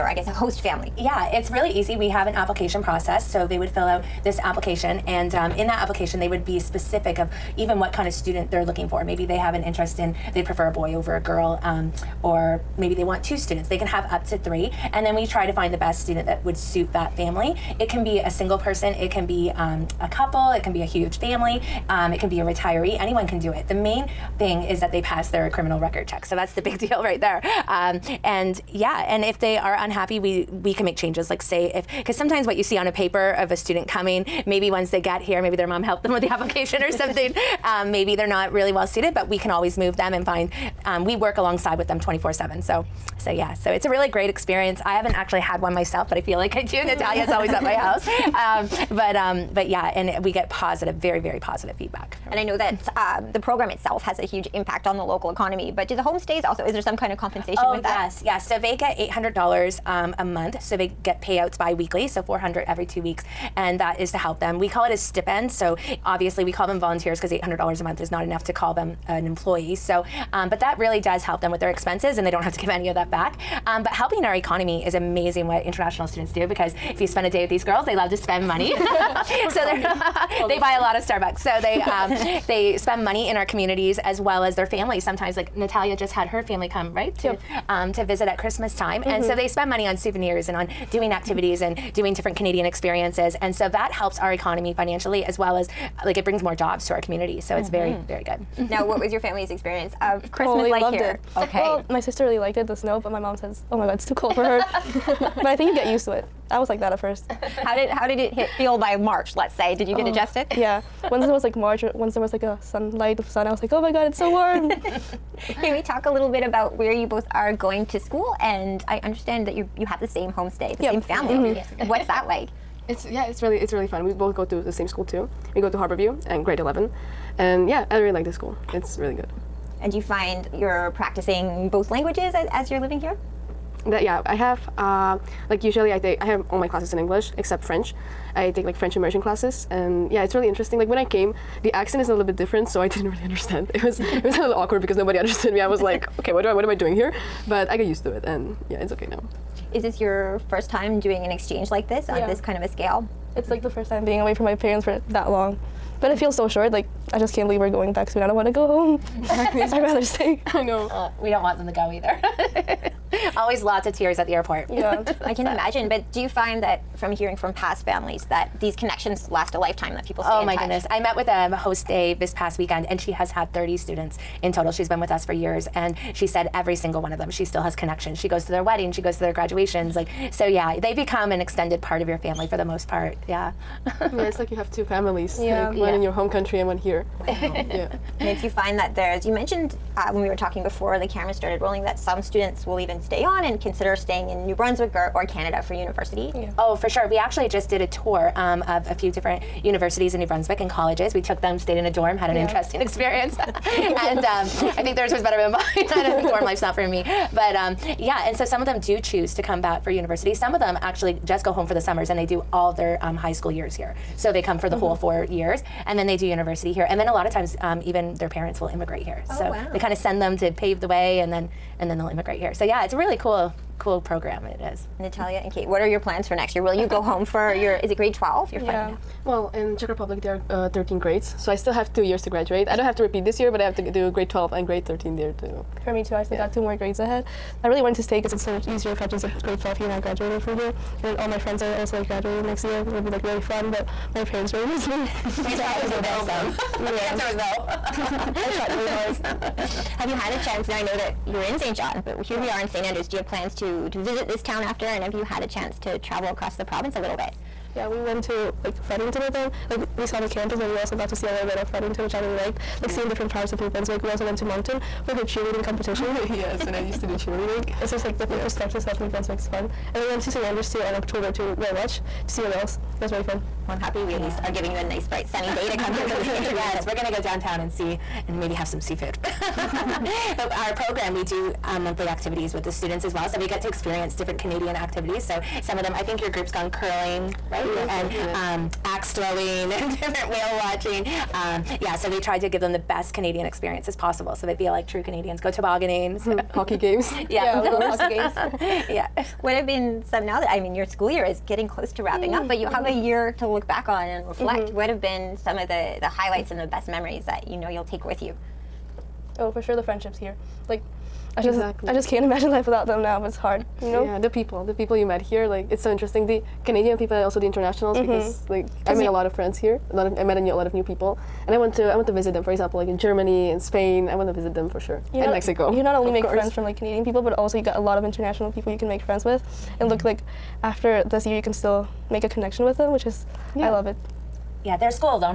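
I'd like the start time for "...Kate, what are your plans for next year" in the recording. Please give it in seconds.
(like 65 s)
225 s.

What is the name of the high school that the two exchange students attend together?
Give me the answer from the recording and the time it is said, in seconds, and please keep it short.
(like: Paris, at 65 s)
Harborview, at 125 s.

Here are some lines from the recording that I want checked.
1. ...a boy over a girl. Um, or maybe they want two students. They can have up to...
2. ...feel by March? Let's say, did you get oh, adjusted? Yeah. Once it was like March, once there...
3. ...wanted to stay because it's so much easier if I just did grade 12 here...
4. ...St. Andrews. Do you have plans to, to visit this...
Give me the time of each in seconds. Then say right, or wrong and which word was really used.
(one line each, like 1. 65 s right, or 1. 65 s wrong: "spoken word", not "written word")
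1. 10 s right
2. 108 s right
3. 237 s right
4. 252 s right.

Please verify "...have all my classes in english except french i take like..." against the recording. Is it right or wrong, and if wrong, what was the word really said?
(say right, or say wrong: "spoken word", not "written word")
right.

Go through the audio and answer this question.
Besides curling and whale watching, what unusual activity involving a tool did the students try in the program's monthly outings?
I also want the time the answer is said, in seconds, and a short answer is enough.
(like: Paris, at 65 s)
Axe throwing, at 288 s.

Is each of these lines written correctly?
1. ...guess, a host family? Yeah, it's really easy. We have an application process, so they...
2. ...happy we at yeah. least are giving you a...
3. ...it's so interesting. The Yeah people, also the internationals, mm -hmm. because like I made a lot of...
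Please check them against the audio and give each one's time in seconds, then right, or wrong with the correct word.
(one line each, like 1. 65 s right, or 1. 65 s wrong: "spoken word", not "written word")
1. 0 s right
2. 273 s right
3. 315 s wrong: "Canadian", not "Yeah".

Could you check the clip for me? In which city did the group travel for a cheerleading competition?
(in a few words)
Moncton.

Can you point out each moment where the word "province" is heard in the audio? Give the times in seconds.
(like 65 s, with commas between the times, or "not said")
256 s.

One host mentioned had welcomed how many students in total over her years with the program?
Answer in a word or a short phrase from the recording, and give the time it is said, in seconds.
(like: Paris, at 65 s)
30, at 173 s.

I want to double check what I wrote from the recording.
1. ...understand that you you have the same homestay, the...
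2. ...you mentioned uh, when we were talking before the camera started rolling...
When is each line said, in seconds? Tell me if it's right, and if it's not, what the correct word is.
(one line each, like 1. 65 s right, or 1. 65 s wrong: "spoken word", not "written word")
1. 119 s right
2. 189 s right.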